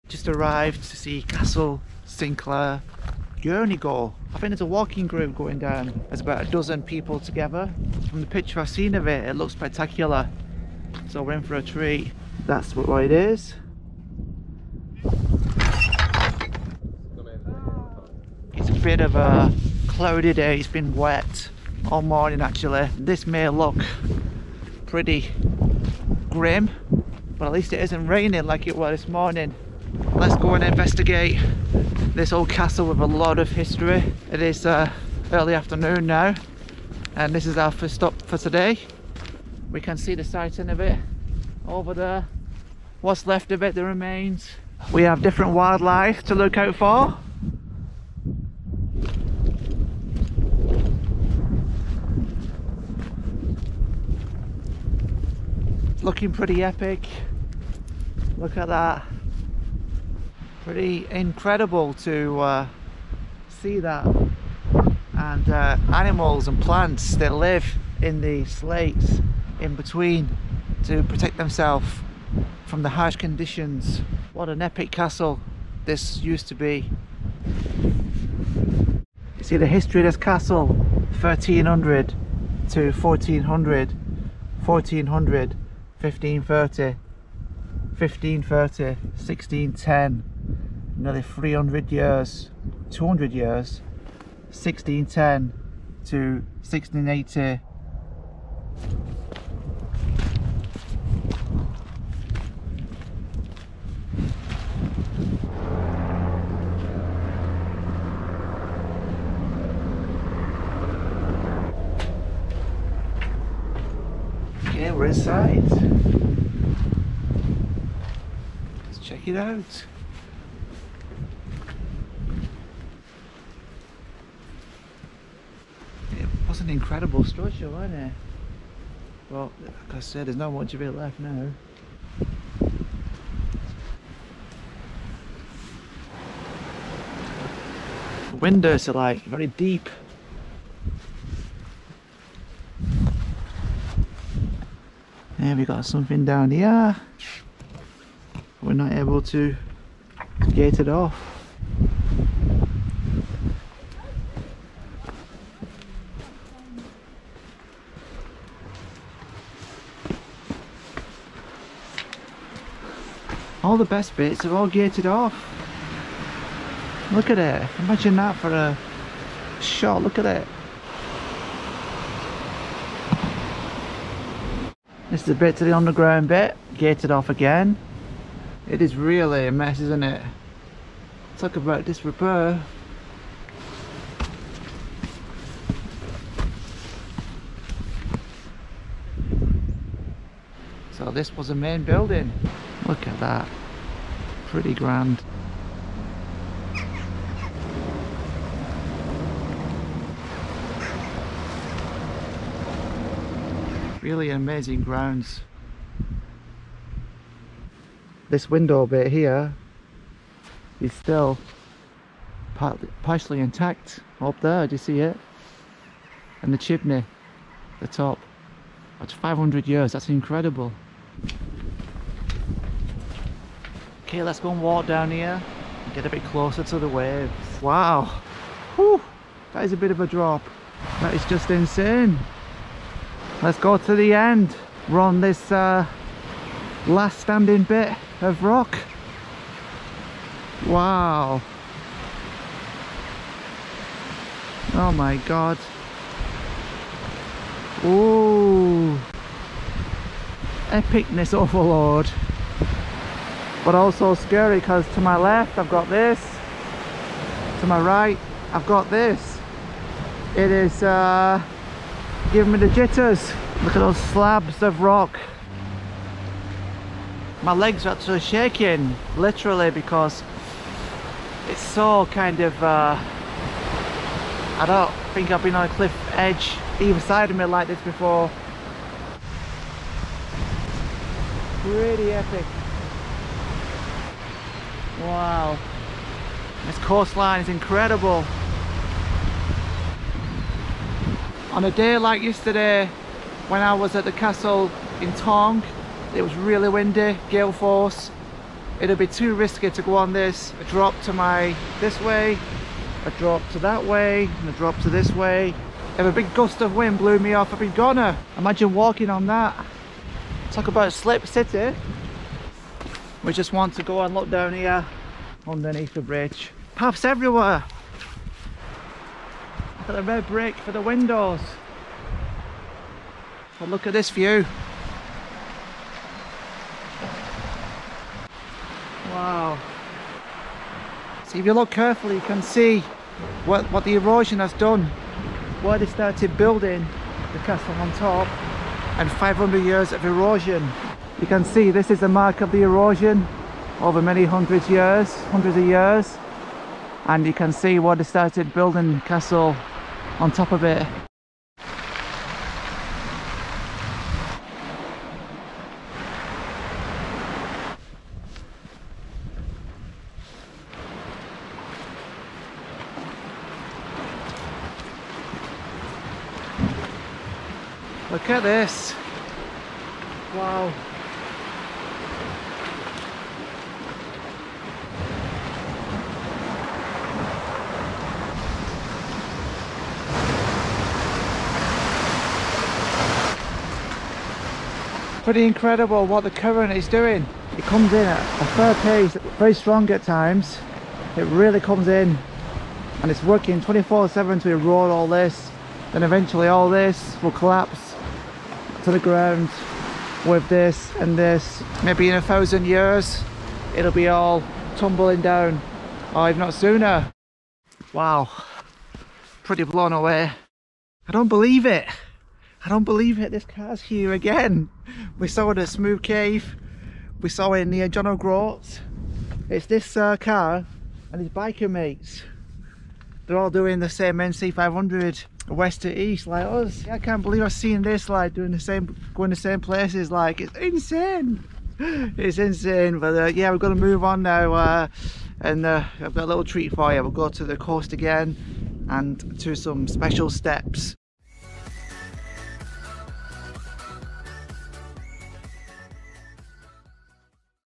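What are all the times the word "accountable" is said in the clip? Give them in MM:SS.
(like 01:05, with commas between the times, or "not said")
not said.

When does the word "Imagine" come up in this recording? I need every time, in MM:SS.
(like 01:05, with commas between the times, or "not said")
02:47, 05:08.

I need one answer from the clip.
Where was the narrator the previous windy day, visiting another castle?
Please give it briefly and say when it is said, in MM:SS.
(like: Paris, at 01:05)
Tongue, at 04:55.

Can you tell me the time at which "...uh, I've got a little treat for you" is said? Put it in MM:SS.
07:15.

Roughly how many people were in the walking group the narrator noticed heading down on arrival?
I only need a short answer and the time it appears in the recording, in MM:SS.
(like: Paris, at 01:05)
a dozen, at 00:06.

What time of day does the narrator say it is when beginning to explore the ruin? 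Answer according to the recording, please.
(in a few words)
early afternoon.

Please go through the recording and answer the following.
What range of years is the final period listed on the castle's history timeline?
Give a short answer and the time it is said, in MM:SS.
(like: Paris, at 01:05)
1610 to 1680, at 01:34.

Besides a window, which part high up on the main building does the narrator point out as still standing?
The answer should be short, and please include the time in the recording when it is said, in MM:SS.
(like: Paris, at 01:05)
the chimney, at 03:36.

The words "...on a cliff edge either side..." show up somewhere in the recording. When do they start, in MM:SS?
04:35.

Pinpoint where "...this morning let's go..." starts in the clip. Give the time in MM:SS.
00:29.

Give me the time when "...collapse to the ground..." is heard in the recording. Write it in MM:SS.
06:37.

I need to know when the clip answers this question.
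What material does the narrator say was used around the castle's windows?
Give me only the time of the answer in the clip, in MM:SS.
05:20.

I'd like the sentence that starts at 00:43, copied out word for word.
What's left of it, the remains.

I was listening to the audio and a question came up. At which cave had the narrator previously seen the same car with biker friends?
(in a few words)
Smoo Cave.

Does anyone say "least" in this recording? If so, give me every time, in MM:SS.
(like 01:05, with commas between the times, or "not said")
00:27.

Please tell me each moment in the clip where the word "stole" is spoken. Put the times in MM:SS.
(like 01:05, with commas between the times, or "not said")
not said.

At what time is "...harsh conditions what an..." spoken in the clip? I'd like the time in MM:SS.
01:12.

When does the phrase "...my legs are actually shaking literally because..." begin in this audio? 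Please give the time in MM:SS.
04:27.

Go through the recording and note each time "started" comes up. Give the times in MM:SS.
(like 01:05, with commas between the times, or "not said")
05:35, 05:48.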